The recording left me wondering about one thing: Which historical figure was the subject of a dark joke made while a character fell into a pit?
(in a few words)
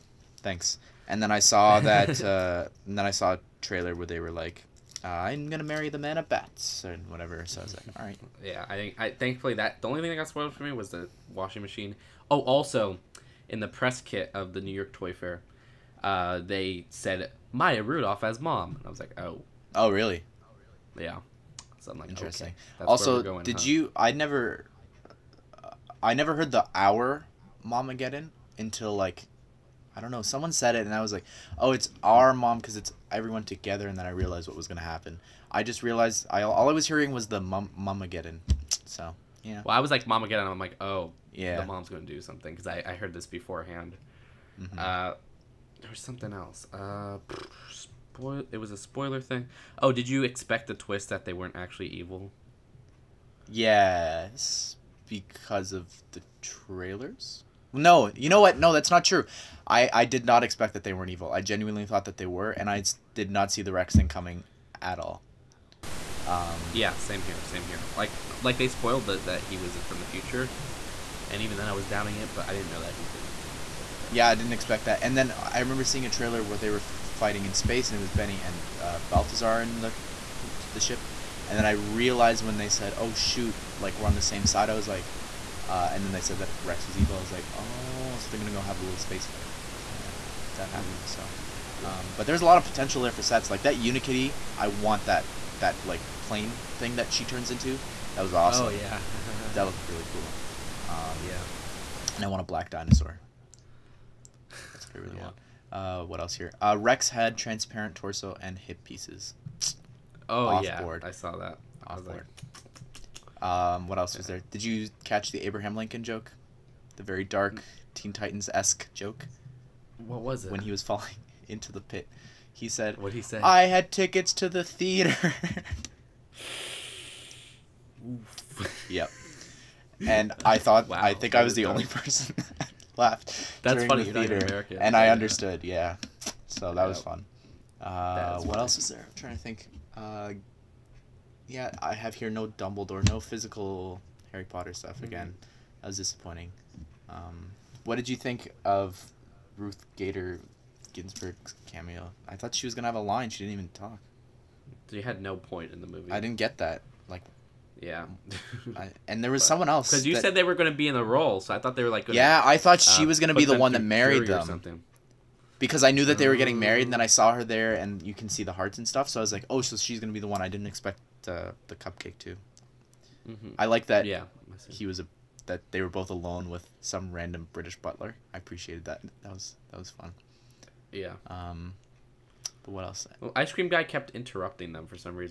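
Abraham Lincoln.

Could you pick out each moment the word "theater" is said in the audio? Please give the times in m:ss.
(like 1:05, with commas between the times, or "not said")
2:04, 2:14.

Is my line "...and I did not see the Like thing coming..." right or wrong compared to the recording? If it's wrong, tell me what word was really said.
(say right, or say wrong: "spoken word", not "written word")
wrong: "Rex", not "Like".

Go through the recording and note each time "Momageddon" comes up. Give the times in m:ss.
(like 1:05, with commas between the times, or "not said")
0:27, 0:37.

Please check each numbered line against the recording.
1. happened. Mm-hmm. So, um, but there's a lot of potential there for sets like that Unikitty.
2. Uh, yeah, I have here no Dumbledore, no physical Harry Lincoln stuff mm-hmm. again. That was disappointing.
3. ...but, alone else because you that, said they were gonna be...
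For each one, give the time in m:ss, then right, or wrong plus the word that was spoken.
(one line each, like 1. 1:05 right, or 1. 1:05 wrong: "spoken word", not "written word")
1. 1:30 right
2. 2:19 wrong: "Potter", not "Lincoln"
3. 2:39 wrong: "someone", not "alone".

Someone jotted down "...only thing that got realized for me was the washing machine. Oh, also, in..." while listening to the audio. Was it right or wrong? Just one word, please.
wrong.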